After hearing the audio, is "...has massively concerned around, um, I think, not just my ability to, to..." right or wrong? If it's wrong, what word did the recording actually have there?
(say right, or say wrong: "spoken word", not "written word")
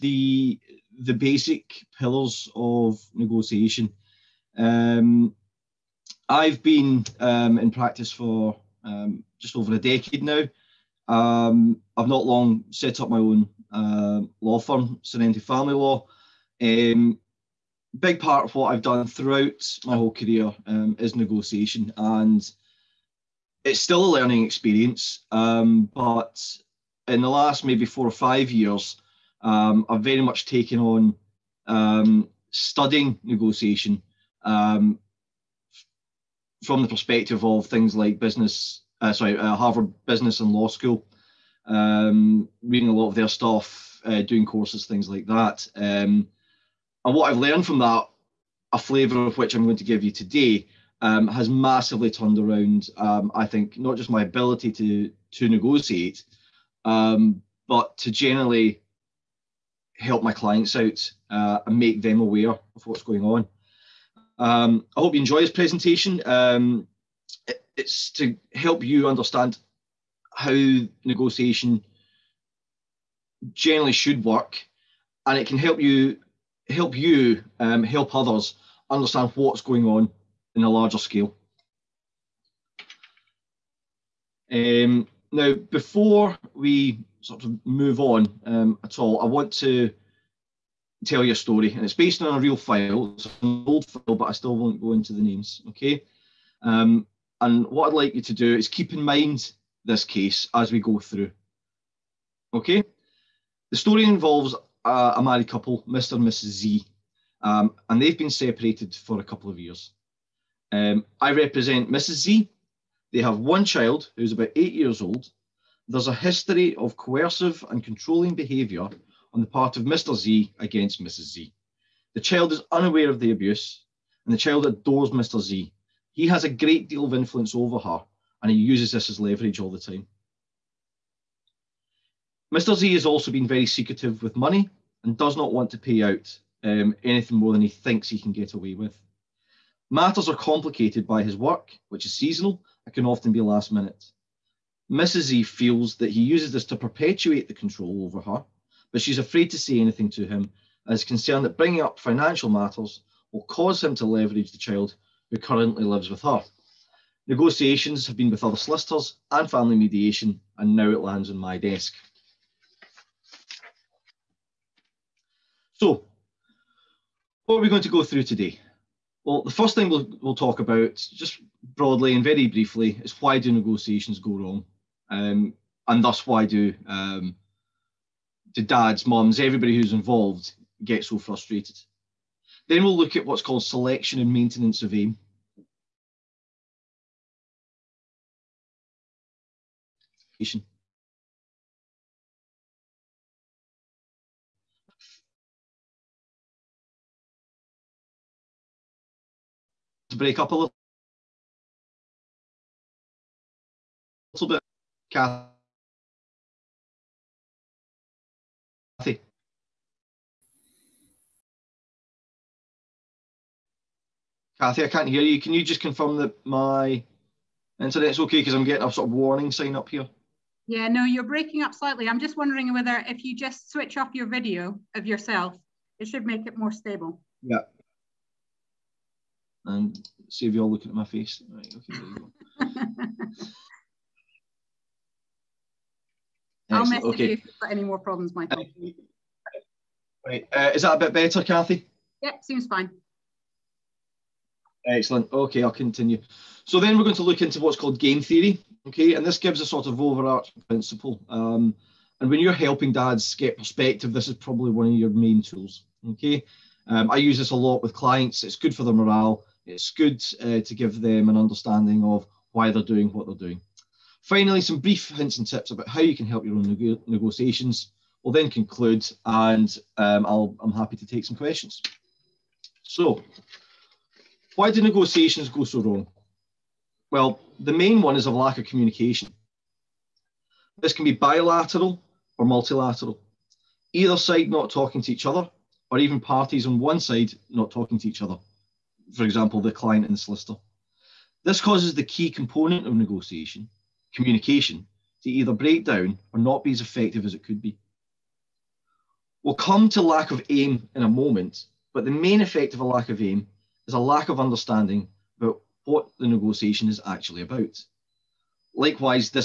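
wrong: "turned", not "concerned".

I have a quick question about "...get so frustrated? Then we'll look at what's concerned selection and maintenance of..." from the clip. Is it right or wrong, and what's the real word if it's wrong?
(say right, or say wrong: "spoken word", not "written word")
wrong: "called", not "concerned".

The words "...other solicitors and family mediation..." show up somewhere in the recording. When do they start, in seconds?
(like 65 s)
158 s.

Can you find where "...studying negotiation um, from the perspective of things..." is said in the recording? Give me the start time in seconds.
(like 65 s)
32 s.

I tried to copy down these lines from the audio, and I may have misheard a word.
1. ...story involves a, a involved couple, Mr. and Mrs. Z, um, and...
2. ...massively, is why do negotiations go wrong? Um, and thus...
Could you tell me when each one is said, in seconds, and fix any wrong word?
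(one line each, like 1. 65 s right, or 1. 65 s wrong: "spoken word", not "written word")
1. 103 s wrong: "married", not "involved"
2. 172 s wrong: "briefly", not "massively".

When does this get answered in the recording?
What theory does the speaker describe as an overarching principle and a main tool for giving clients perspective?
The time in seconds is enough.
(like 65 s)
247 s.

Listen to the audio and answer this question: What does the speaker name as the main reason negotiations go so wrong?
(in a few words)
lack of communication.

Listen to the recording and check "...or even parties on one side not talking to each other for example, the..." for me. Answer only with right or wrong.
right.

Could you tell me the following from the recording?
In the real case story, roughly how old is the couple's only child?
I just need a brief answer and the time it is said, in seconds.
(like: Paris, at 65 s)
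8, at 114 s.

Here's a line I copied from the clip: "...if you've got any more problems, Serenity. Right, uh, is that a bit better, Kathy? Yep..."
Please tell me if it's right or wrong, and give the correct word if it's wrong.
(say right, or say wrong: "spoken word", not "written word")
wrong: "Michael", not "Serenity".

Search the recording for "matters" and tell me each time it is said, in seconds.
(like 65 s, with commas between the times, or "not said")
139 s, 152 s.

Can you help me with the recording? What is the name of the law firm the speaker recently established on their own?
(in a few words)
Serenity Family Law.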